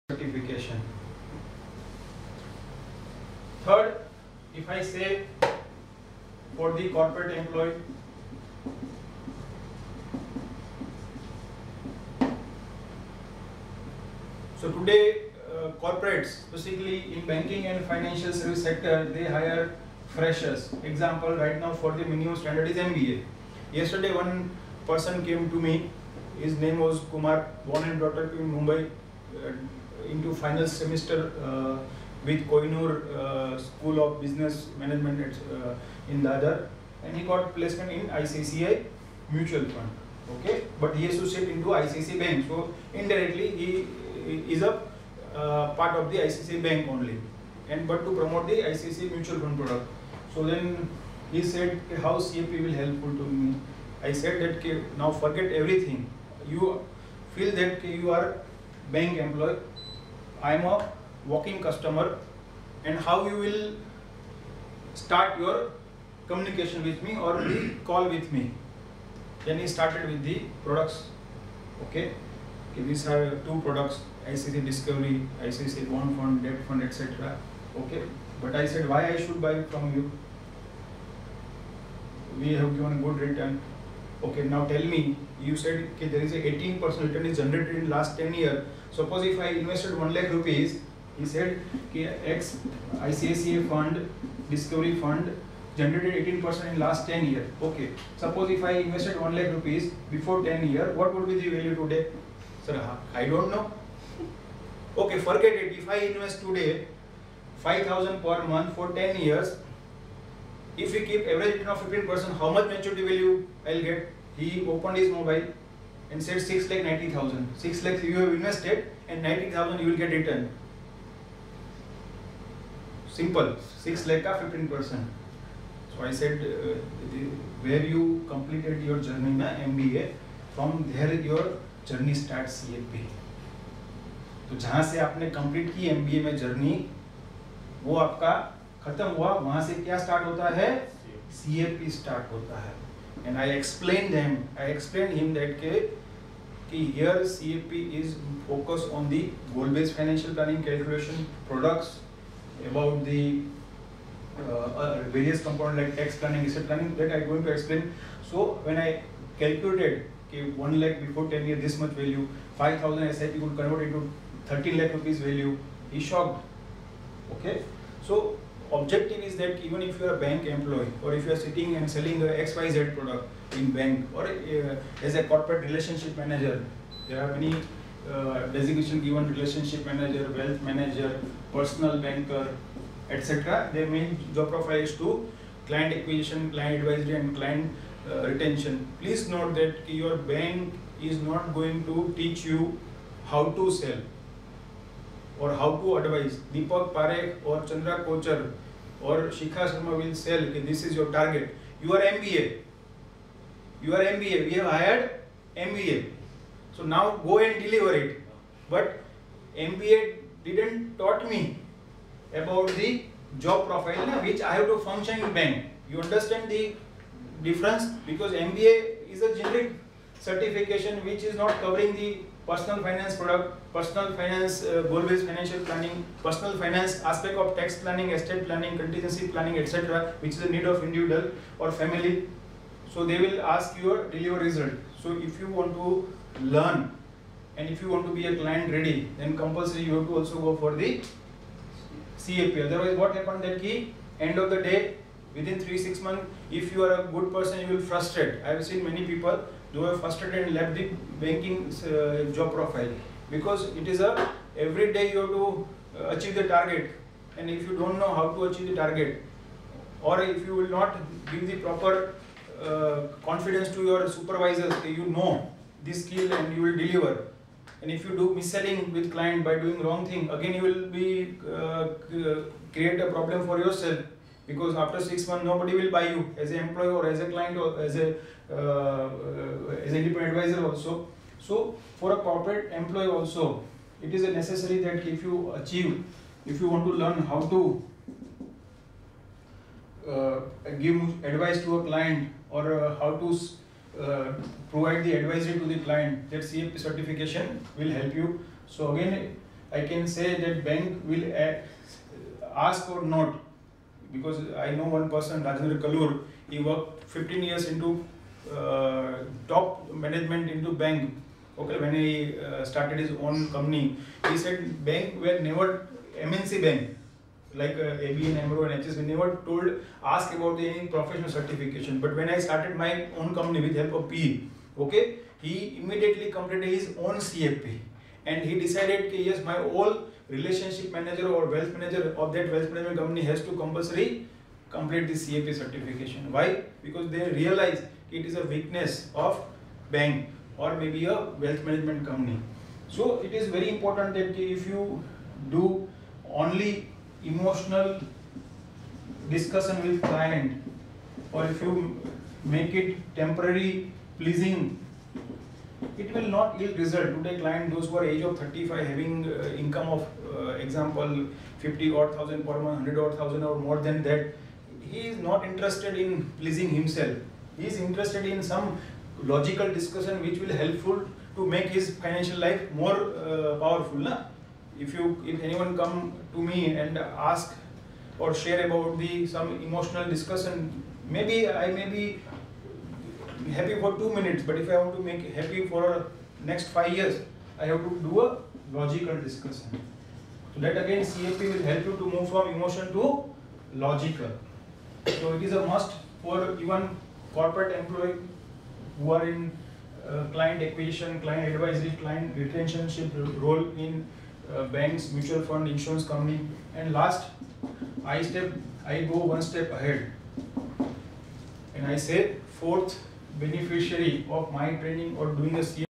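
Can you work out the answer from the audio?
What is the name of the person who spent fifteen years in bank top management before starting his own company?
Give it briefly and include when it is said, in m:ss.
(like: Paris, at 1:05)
Rajendra Kalur, at 5:05.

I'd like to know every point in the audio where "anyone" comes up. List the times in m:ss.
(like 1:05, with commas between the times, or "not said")
6:15.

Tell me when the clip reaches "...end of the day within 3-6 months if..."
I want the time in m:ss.
4:04.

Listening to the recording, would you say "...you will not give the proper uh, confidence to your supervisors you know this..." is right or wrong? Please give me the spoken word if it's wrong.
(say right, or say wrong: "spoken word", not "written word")
right.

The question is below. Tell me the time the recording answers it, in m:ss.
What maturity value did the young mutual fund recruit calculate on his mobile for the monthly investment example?
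1:56.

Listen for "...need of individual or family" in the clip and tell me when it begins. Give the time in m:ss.
3:50.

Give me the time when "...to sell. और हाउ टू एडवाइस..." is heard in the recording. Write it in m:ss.
3:13.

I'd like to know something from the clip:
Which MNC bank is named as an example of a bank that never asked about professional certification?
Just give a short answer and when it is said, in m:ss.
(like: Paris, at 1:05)
ABN AMRO, at 5:18.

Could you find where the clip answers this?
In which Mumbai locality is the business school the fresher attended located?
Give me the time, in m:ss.
0:36.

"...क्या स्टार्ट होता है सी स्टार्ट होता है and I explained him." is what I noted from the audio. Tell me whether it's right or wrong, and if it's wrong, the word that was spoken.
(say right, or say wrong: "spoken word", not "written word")
right.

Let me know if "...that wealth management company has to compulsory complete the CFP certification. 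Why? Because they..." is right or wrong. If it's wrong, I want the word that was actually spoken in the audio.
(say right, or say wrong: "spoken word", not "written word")
right.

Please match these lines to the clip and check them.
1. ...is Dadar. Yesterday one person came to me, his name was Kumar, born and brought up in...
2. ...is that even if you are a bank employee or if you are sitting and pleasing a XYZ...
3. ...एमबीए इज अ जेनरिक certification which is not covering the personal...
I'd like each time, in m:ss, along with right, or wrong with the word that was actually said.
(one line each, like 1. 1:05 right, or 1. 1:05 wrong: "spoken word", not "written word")
1. 0:22 wrong: "MBA", not "Dadar"
2. 2:49 wrong: "selling", not "pleasing"
3. 3:38 right.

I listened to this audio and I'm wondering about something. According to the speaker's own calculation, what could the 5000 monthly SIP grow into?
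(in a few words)
13 lakh rupees.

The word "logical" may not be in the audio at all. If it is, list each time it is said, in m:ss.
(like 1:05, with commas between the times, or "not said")
6:09, 6:28, 6:33.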